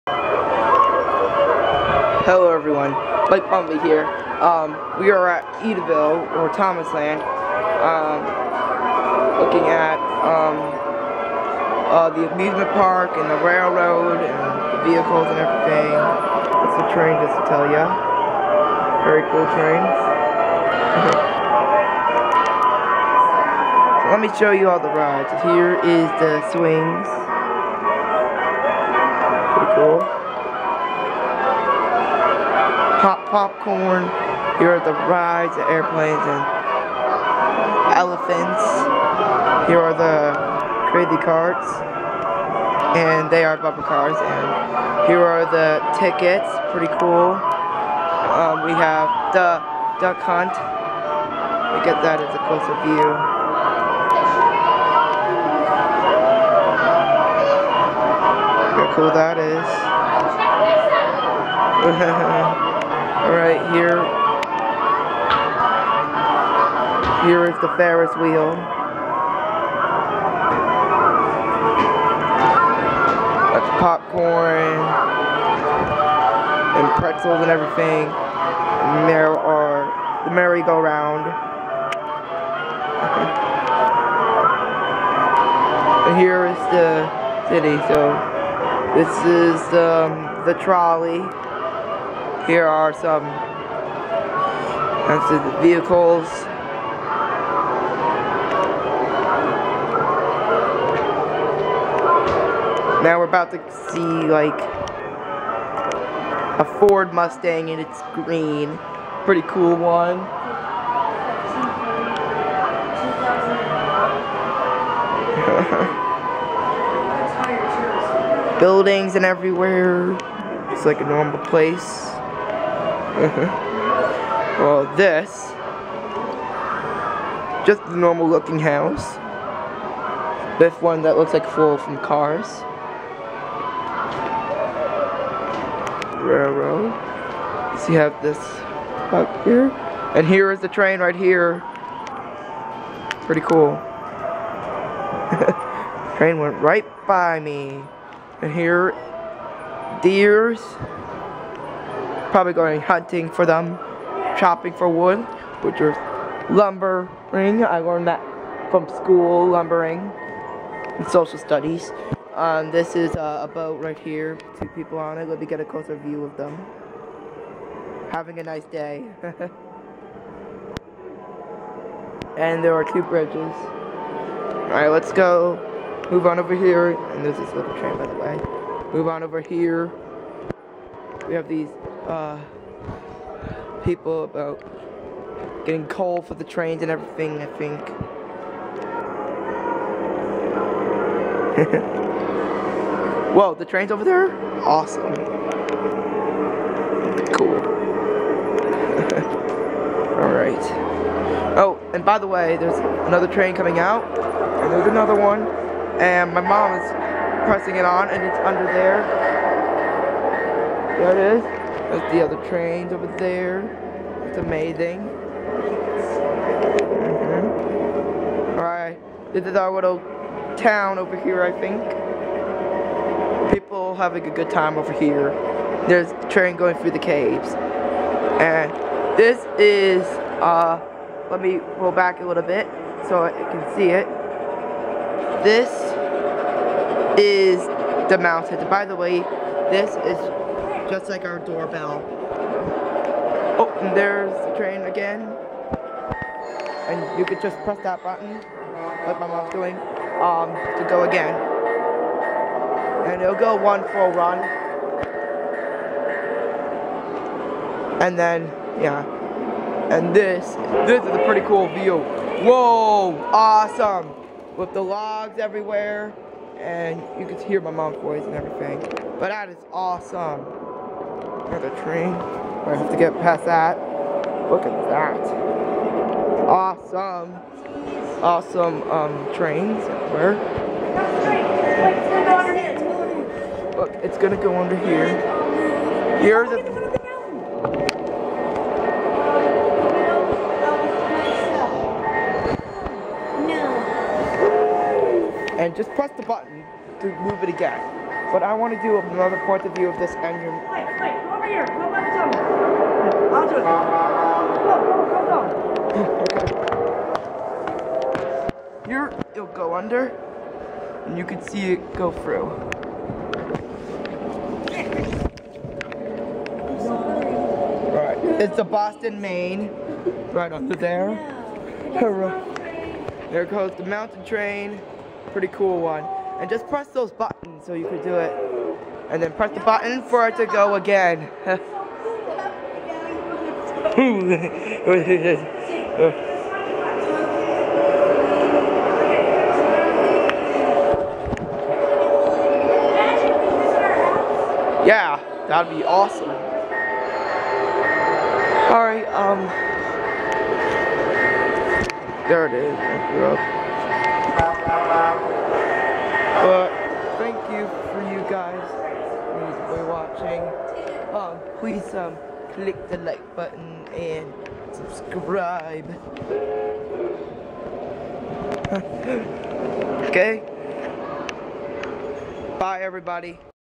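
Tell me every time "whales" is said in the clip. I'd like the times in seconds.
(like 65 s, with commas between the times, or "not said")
not said.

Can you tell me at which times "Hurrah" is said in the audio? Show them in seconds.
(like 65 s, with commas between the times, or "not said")
321 s.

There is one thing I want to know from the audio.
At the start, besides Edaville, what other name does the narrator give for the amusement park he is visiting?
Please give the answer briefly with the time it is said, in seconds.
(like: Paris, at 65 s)
Thomasland, at 6 s.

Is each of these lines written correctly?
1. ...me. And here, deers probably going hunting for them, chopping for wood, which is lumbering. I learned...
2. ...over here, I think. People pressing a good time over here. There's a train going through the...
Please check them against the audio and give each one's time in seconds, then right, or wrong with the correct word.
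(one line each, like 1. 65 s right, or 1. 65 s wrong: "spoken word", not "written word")
1. 147 s right
2. 220 s wrong: "having", not "pressing".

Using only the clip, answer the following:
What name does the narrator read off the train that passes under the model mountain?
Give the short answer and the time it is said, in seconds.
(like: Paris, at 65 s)
Boston, Maine, at 318 s.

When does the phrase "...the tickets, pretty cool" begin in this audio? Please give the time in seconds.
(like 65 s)
45 s.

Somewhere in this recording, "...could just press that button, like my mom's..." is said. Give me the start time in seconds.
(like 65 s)
247 s.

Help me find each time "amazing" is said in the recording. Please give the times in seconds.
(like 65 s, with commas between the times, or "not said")
214 s.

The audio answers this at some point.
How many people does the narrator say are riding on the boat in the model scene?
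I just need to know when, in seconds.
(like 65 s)
164 s.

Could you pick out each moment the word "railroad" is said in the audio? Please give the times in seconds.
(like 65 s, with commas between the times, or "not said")
13 s, 136 s.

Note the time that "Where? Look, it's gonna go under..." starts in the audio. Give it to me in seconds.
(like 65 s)
280 s.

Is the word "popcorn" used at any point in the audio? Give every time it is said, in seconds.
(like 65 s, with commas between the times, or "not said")
33 s, 73 s.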